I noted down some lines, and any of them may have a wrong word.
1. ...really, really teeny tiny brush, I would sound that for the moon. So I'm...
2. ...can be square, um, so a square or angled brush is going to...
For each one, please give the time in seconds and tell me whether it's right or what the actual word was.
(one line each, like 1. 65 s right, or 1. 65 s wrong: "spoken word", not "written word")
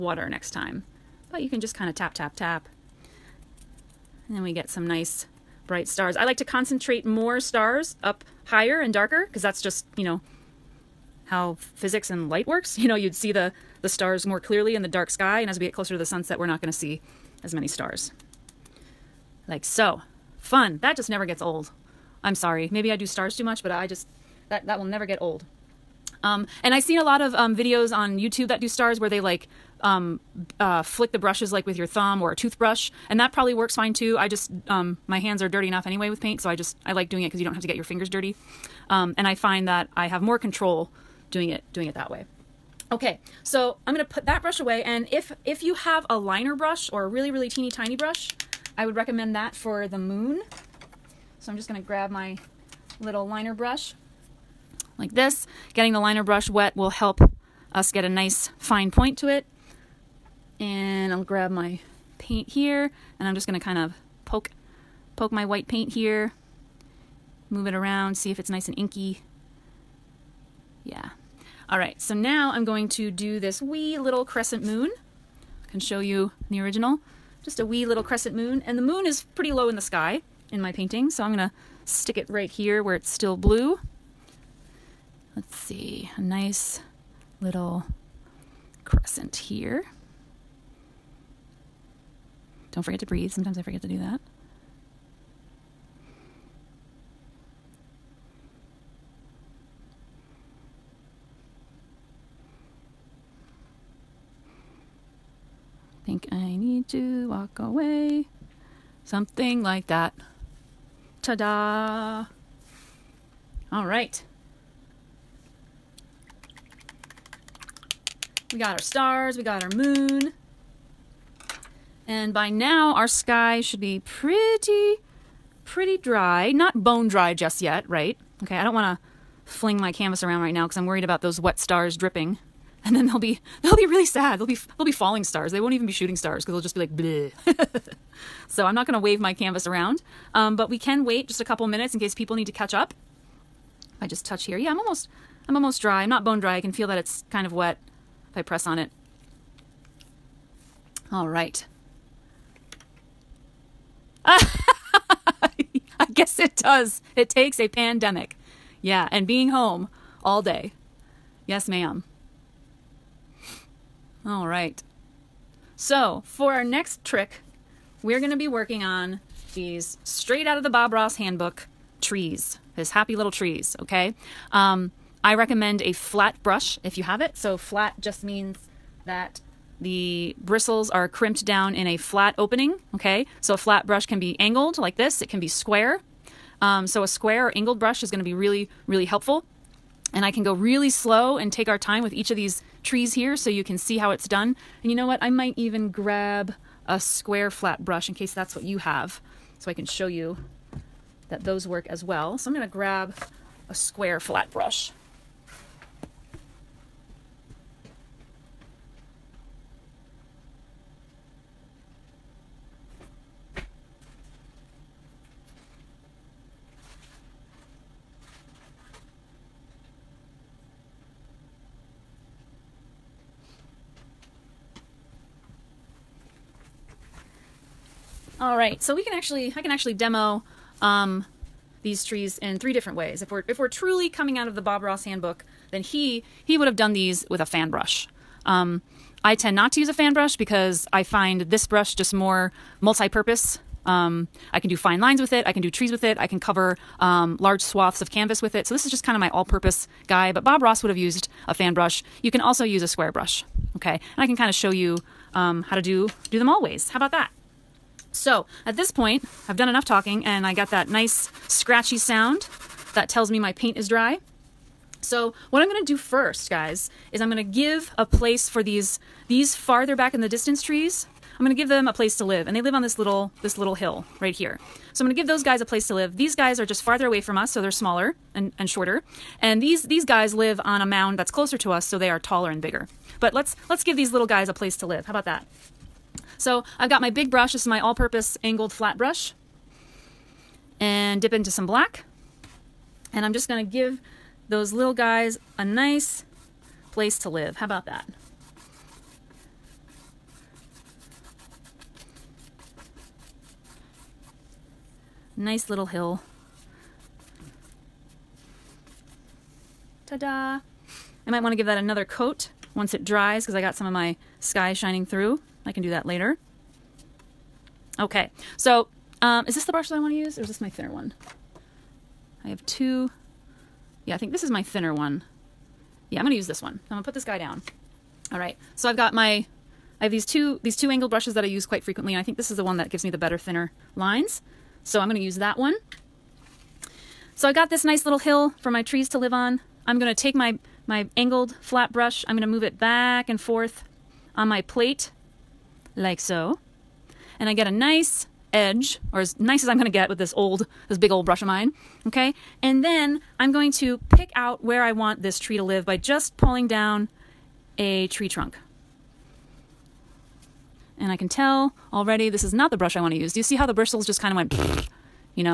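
1. 47 s wrong: "recommend", not "sound"
2. 185 s right.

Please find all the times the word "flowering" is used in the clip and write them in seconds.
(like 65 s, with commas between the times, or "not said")
not said.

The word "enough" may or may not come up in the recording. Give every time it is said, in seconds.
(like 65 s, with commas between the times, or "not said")
35 s, 259 s.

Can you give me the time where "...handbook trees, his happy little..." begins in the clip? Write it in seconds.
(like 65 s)
171 s.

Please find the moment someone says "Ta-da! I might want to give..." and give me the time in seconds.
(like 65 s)
310 s.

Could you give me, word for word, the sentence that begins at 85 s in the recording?
Let's see, a nice little crescent here.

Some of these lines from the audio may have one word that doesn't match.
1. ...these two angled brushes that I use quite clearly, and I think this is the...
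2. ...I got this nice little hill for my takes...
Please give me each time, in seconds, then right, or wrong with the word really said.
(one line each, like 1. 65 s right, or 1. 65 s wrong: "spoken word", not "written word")
1. 330 s wrong: "frequently", not "clearly"
2. 337 s wrong: "trees", not "takes".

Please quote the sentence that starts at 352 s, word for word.
And then I'm going to pick out where I want this tree to live by just pulling down a tree trunk.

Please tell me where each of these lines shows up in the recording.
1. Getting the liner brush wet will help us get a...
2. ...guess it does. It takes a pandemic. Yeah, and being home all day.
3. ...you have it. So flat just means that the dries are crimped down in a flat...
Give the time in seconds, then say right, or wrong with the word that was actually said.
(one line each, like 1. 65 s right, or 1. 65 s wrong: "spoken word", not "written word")
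1. 55 s right
2. 156 s right
3. 176 s wrong: "bristles", not "dries".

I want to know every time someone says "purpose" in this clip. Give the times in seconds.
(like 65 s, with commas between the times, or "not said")
242 s, 249 s, 287 s.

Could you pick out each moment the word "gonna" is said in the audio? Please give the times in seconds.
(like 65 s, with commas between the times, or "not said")
43 s, 51 s, 63 s, 81 s, 138 s.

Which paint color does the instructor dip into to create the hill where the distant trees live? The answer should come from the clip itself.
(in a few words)
black.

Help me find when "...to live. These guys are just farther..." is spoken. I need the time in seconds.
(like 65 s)
275 s.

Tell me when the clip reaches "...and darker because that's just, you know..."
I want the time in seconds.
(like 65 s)
8 s.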